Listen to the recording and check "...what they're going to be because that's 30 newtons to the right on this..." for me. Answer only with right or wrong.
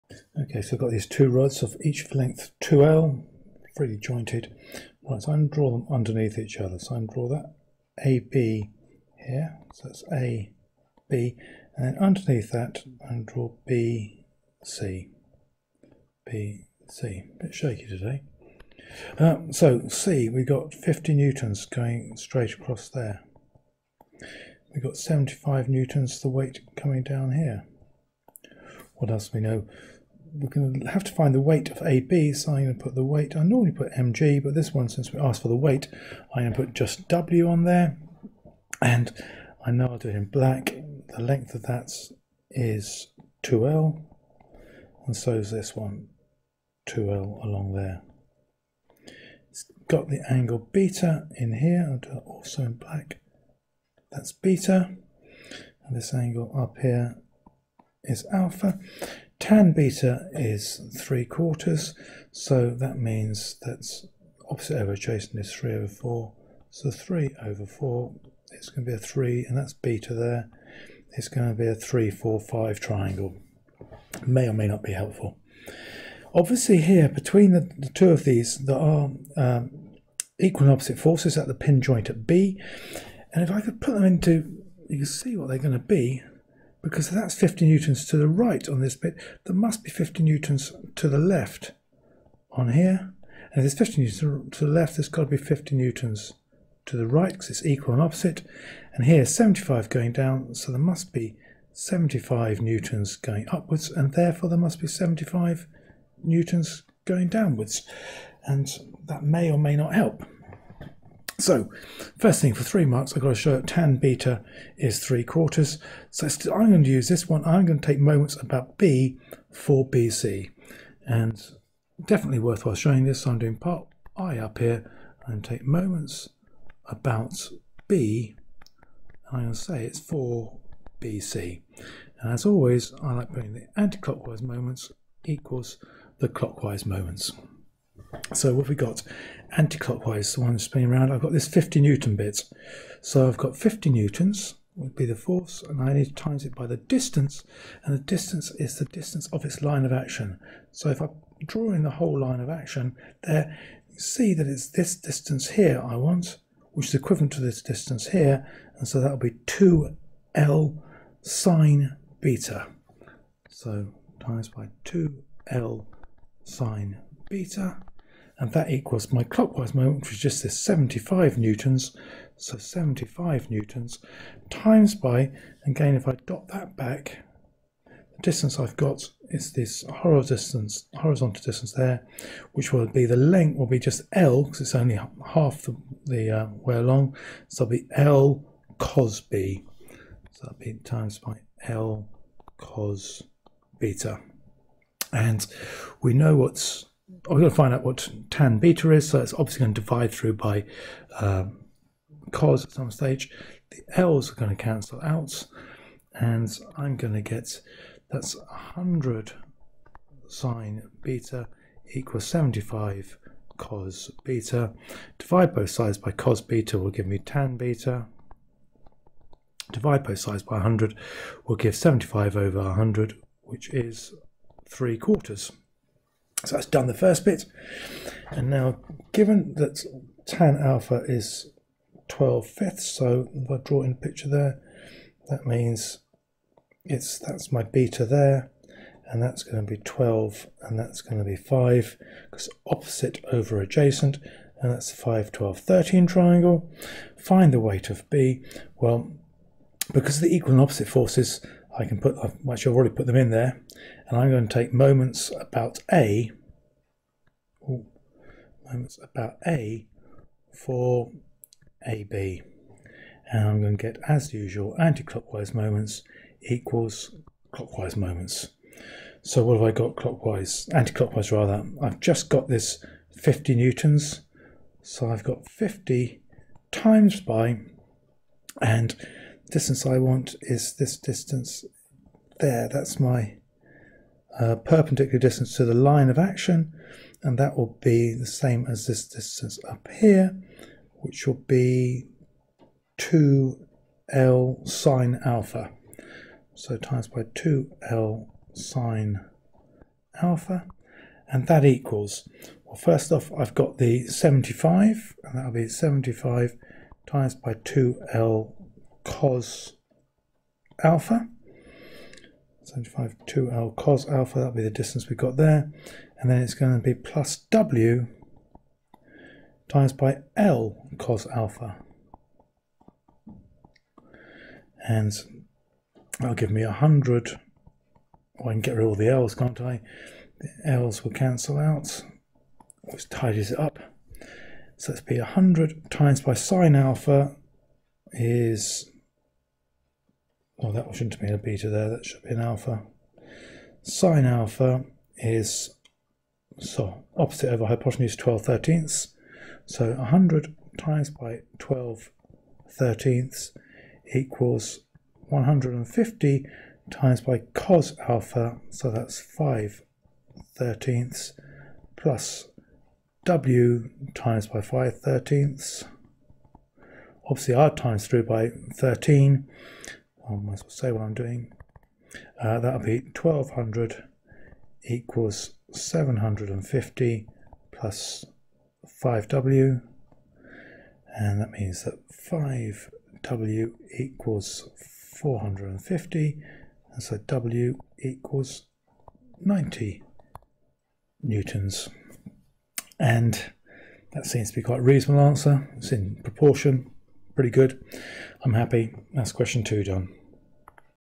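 wrong.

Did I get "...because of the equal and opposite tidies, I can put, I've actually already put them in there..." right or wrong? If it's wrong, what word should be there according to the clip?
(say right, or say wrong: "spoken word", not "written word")
wrong: "forces", not "tidies".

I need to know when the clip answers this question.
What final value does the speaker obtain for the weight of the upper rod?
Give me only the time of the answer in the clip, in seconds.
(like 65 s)
389 s.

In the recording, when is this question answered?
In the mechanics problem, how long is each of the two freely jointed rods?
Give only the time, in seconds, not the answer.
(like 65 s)
1 s.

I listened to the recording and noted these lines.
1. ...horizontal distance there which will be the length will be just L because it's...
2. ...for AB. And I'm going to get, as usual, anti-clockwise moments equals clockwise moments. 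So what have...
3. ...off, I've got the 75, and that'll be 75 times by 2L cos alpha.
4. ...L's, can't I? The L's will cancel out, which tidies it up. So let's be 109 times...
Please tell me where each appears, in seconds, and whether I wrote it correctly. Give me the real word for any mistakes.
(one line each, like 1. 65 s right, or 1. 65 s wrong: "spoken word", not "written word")
1. 180 s right
2. 260 s right
3. 303 s right
4. 329 s wrong: "100", not "109".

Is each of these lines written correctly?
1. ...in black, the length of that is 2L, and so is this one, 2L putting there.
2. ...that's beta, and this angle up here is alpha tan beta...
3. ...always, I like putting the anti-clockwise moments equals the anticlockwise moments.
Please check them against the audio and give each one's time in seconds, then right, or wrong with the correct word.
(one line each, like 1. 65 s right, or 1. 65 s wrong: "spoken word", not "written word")
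1. 40 s wrong: "along", not "putting"
2. 54 s right
3. 132 s wrong: "clockwise", not "anticlockwise".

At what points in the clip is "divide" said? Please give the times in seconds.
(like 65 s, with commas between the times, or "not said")
199 s, 215 s, 219 s.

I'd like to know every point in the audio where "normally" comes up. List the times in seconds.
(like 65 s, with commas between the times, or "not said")
33 s.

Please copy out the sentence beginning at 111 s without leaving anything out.
So, first thing for three marks, I've got to show that tan beta is three quarters.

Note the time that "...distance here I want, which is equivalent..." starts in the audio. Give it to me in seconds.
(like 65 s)
154 s.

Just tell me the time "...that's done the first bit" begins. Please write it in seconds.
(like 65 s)
226 s.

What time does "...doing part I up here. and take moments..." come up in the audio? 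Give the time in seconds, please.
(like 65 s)
123 s.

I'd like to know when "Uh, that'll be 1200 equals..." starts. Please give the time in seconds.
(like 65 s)
372 s.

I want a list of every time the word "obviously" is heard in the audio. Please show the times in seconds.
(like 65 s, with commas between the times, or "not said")
76 s, 199 s, 367 s.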